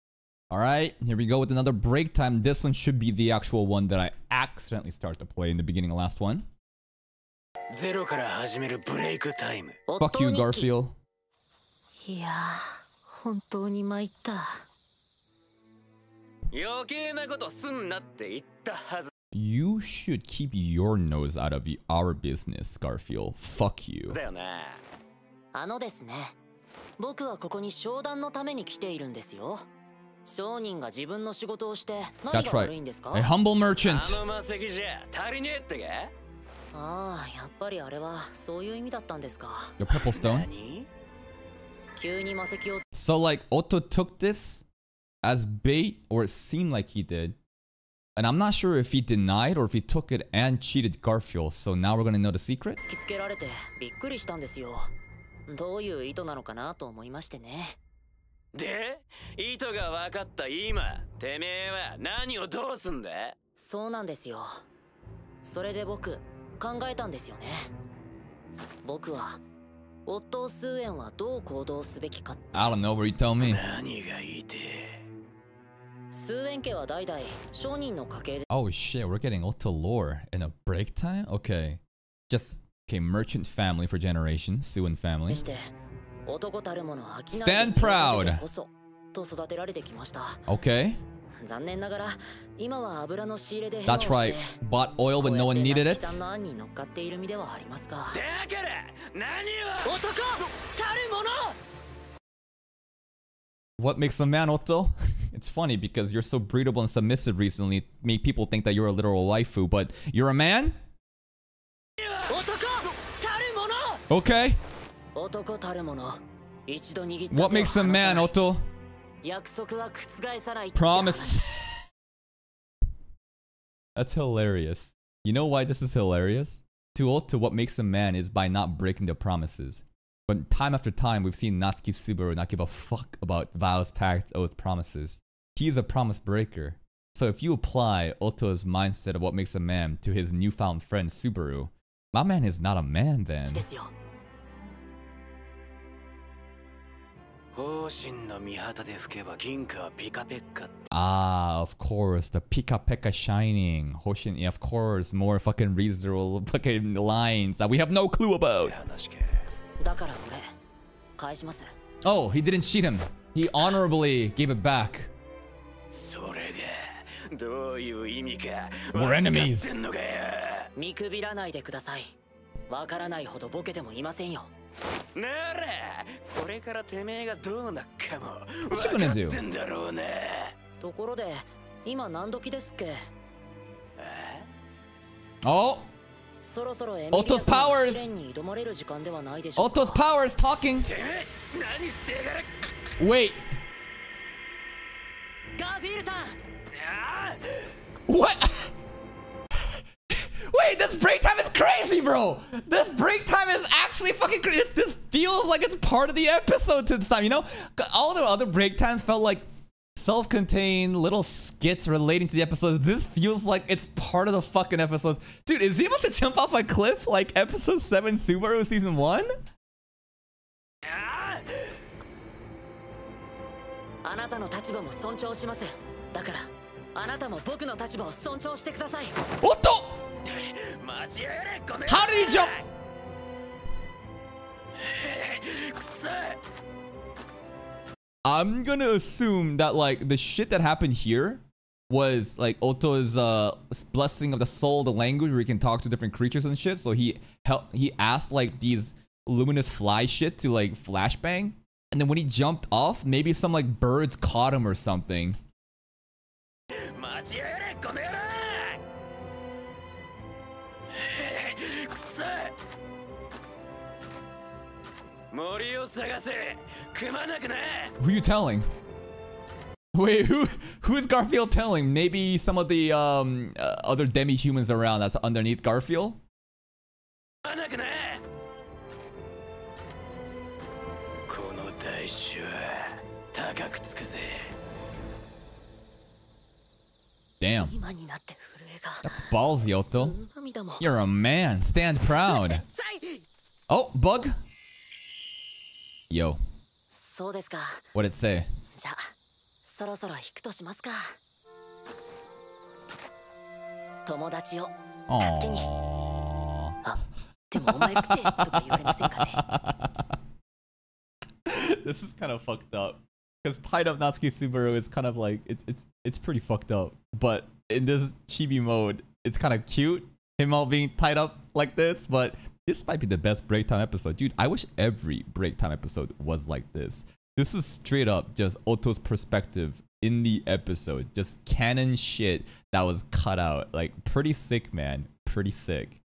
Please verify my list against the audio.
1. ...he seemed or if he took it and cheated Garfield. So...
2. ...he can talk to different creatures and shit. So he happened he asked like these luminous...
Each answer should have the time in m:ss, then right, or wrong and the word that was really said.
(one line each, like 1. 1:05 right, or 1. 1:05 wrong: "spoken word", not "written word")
1. 0:48 wrong: "denied", not "seemed"
2. 4:05 wrong: "helped", not "happened".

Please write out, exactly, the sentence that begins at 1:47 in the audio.
It made people think that you're a literal waifu, but you're a man?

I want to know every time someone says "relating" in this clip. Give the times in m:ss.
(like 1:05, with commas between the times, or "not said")
3:31.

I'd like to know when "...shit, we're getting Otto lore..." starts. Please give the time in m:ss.
1:18.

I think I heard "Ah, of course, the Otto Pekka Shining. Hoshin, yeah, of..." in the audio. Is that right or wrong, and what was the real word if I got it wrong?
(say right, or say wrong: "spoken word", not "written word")
wrong: "Pika", not "Otto".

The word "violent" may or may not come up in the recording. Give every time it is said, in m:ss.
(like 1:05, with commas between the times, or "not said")
not said.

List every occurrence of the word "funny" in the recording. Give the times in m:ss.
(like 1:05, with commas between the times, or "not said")
1:45.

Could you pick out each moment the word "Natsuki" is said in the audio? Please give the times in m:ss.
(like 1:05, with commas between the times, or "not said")
2:11, 5:13.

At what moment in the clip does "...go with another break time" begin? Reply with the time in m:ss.
0:01.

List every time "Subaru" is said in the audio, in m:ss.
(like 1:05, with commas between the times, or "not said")
2:11, 2:21, 3:38, 5:14.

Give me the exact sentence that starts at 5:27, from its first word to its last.
This is straight up just Otto's perspective in the episode.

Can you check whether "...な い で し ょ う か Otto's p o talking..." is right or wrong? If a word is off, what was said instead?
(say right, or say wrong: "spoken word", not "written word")
right.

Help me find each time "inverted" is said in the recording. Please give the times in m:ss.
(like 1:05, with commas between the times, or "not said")
not said.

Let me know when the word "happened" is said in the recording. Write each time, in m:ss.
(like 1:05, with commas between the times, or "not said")
4:00.